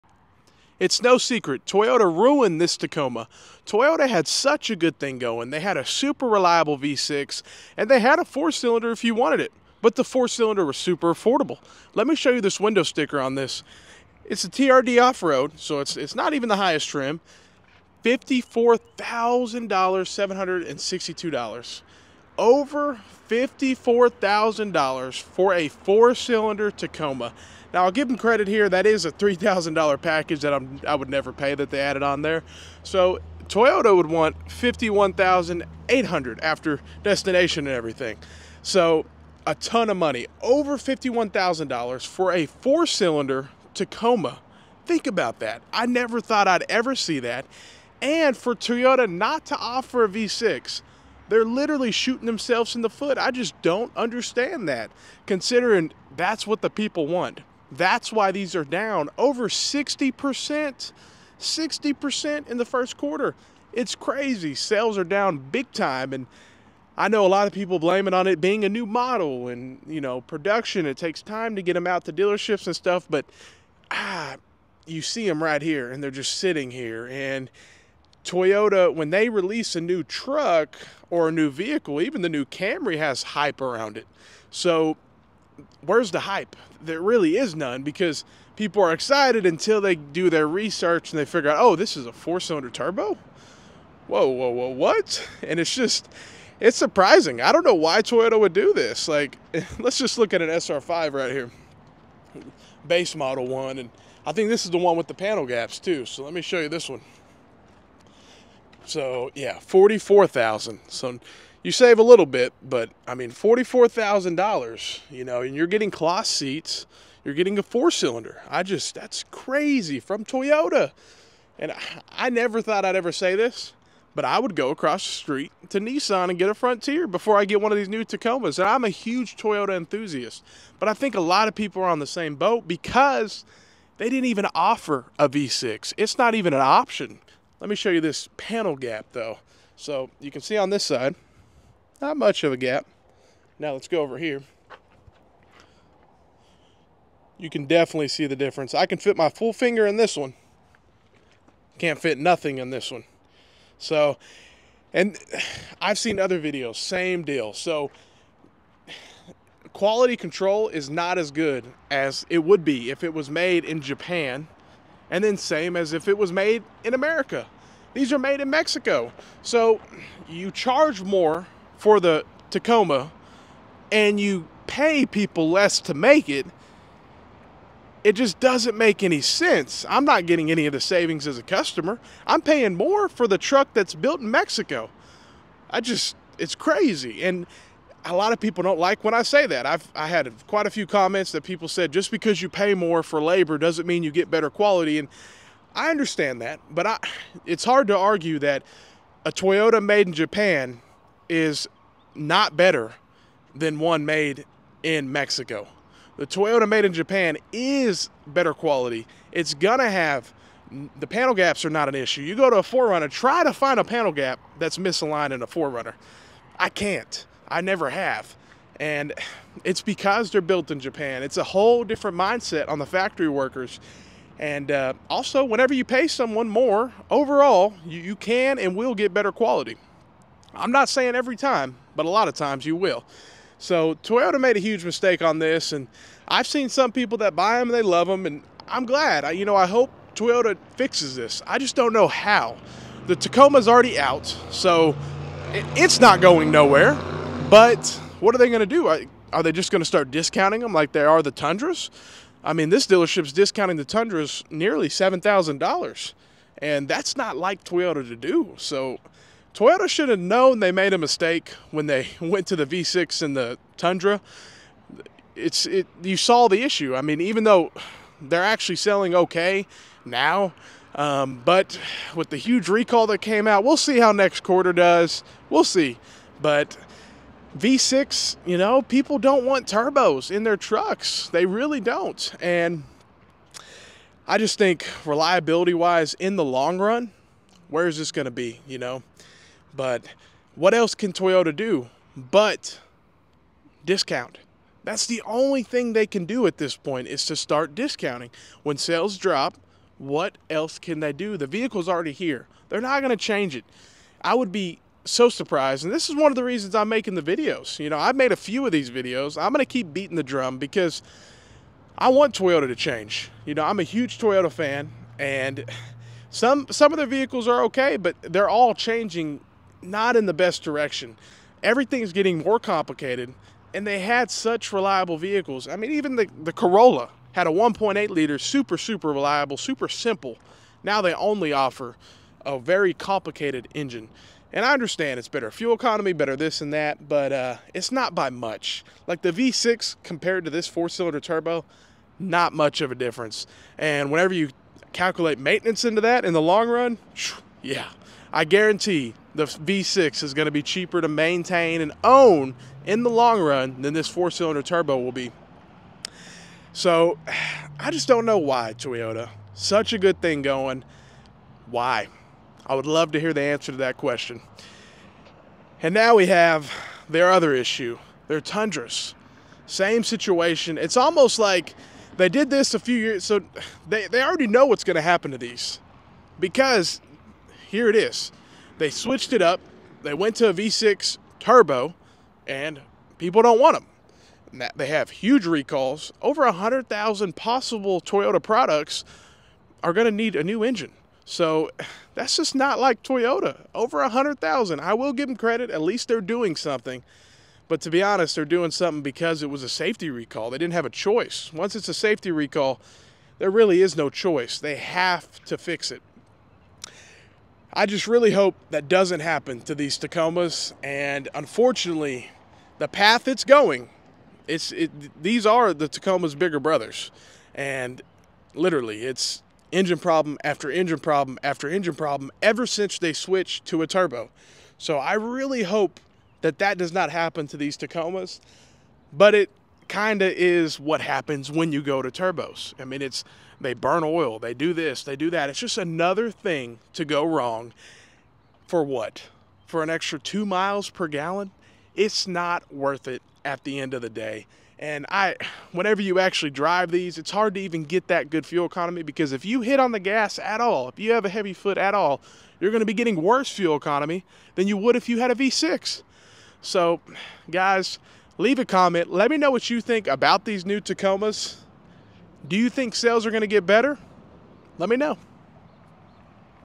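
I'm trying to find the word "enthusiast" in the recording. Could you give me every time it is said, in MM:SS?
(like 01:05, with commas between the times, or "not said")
02:09.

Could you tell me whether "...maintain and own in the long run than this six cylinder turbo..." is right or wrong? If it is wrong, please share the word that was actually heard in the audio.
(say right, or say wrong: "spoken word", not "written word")
wrong: "four", not "six".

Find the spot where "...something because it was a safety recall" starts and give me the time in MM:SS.
06:38.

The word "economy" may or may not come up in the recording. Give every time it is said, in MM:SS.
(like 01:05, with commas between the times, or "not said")
05:35, 07:28, 07:33.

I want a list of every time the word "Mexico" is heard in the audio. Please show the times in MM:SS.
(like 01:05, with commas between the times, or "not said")
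02:48, 03:04, 03:25.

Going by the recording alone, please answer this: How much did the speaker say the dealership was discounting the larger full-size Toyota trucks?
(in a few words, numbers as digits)
$7,000.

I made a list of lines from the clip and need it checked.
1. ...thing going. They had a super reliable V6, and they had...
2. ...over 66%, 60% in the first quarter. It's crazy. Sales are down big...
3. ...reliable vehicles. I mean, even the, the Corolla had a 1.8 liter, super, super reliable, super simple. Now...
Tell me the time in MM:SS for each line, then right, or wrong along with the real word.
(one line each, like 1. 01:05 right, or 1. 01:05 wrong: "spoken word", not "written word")
1. 00:04 right
2. 00:59 wrong: "60", not "66"
3. 05:24 right.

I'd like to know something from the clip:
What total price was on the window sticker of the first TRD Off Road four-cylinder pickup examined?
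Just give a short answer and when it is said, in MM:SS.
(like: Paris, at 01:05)
$54,762, at 00:18.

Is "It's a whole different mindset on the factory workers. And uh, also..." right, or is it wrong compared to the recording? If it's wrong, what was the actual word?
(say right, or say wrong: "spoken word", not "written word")
right.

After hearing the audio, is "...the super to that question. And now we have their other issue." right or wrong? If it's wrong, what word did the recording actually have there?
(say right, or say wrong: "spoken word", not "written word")
wrong: "answer", not "super".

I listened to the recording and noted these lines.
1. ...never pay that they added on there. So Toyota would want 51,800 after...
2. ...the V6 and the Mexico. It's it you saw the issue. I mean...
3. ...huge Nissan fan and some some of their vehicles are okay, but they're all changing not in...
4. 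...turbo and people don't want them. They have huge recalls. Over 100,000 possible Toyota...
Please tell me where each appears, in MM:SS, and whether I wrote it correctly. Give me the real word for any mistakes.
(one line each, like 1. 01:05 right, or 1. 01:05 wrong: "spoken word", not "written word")
1. 00:31 right
2. 04:22 wrong: "Tundra", not "Mexico"
3. 05:13 wrong: "Toyota", not "Nissan"
4. 06:21 right.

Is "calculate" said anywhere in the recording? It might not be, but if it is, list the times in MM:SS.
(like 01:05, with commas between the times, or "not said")
05:44.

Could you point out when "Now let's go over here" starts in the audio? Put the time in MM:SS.
02:23.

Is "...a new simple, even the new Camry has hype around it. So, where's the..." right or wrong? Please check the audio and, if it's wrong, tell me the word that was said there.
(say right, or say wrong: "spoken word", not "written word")
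wrong: "vehicle", not "simple".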